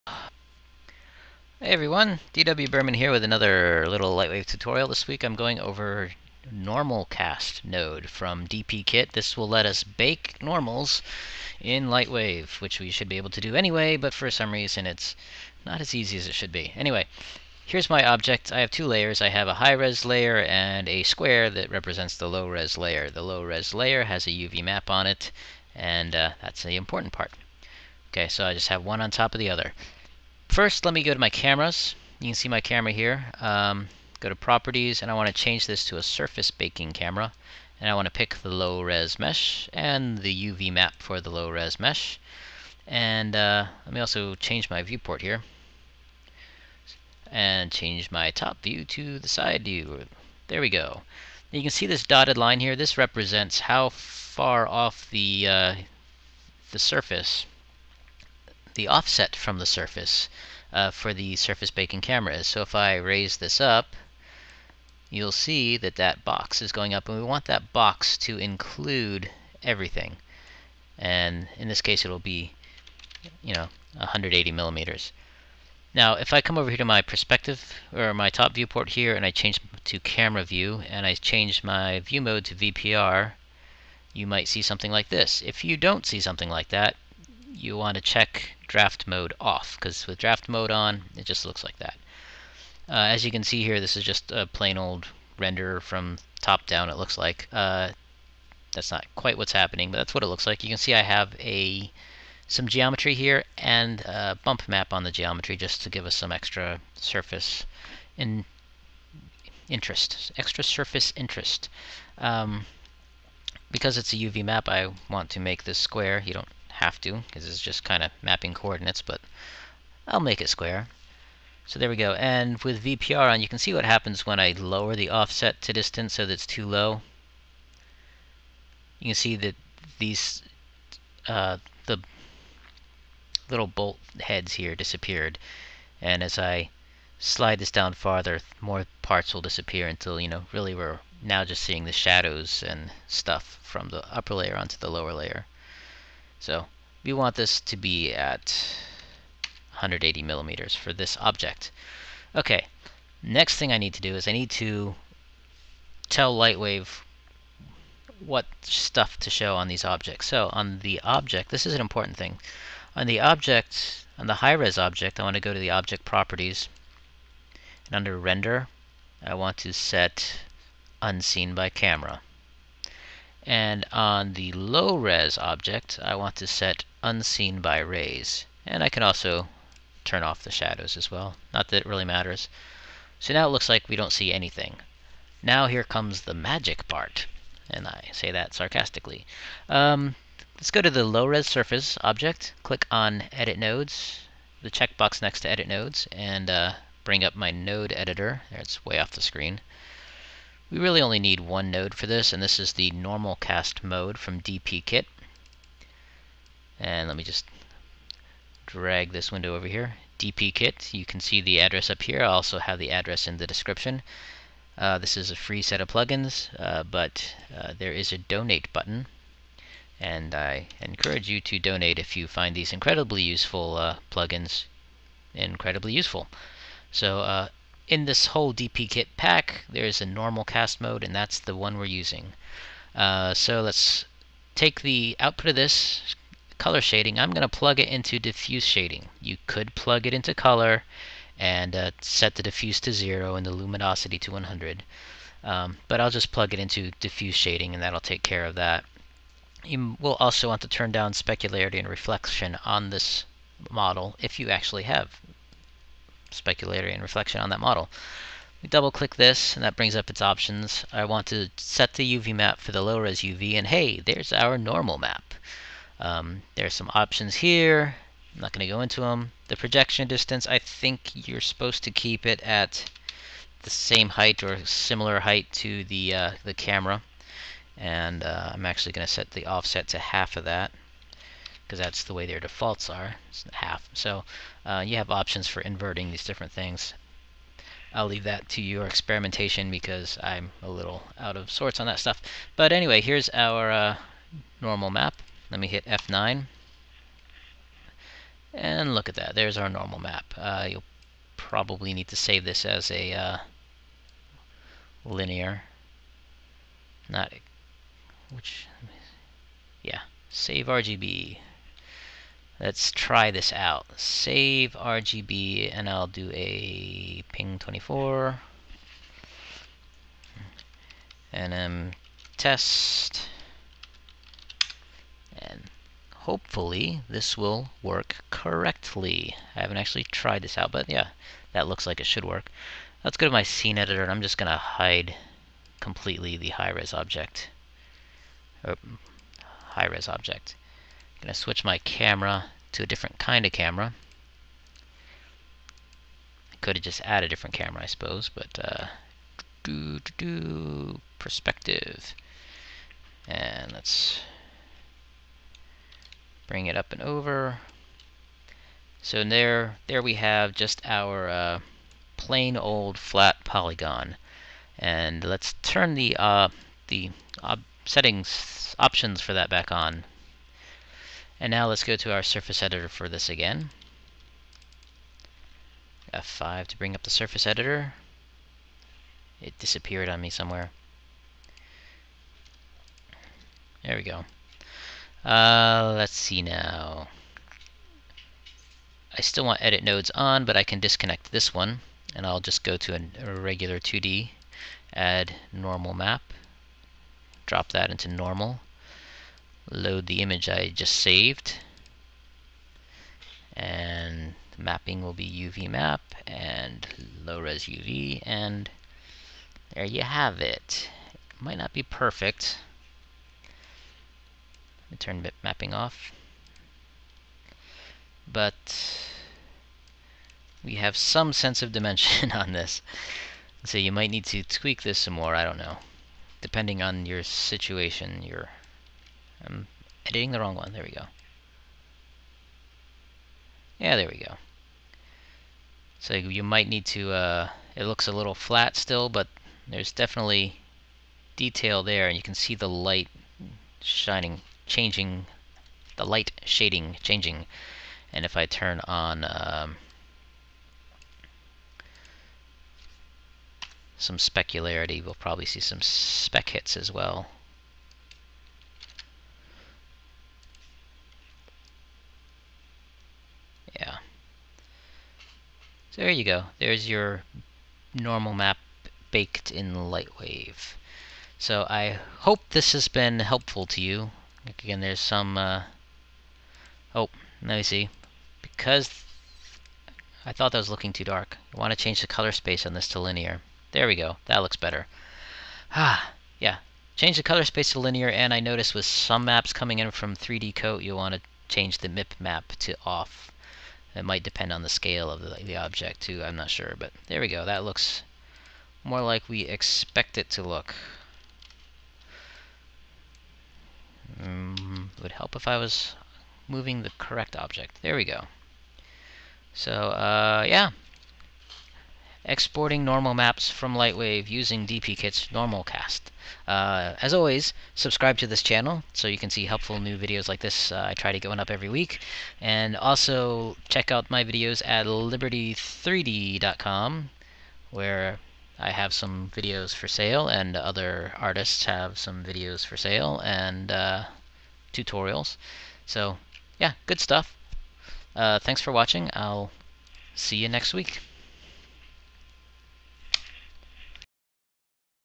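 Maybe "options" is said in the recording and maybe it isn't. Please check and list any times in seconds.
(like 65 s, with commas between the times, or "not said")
260 s, 266 s, 285 s, 368 s.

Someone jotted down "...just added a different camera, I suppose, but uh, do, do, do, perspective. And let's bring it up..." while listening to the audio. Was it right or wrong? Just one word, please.
right.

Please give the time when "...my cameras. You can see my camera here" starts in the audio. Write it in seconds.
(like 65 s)
31 s.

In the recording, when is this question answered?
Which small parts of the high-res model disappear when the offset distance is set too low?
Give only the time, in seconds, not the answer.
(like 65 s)
133 s.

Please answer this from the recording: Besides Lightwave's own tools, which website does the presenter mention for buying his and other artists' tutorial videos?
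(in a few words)
liberty3d.com.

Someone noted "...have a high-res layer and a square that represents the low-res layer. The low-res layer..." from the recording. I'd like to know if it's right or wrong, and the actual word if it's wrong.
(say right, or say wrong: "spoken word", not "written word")
right.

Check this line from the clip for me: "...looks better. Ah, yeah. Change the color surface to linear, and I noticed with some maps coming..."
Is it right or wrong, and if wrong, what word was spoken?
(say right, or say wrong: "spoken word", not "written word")
wrong: "space", not "surface".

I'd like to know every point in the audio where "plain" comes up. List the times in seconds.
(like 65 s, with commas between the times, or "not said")
94 s, 362 s.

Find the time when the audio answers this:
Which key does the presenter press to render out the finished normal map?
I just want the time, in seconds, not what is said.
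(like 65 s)
295 s.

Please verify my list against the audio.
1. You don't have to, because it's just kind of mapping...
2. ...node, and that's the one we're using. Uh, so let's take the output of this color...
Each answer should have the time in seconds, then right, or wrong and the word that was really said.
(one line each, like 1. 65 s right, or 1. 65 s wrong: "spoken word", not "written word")
1. 116 s right
2. 230 s right.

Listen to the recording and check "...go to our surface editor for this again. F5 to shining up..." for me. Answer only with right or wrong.
wrong.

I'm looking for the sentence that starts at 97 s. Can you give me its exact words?
Uh, that's not quite what's happening, but that's what it looks like.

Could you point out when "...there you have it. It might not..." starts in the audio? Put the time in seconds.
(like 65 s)
409 s.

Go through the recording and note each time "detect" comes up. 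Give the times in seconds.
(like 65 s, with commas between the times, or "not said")
not said.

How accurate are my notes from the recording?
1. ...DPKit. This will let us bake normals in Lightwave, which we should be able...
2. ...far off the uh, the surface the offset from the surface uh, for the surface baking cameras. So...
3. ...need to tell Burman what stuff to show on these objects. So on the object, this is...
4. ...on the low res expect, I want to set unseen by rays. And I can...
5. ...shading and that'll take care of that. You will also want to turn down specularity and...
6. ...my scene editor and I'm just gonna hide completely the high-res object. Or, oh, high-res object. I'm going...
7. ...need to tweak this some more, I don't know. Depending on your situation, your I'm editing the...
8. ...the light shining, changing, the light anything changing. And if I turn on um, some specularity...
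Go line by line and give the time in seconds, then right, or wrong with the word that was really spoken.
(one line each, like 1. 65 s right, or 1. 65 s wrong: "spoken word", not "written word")
1. 8 s right
2. 53 s right
3. 154 s wrong: "Lightwave", not "Burman"
4. 173 s wrong: "object", not "expect"
5. 247 s right
6. 333 s right
7. 424 s right
8. 442 s wrong: "shading", not "anything".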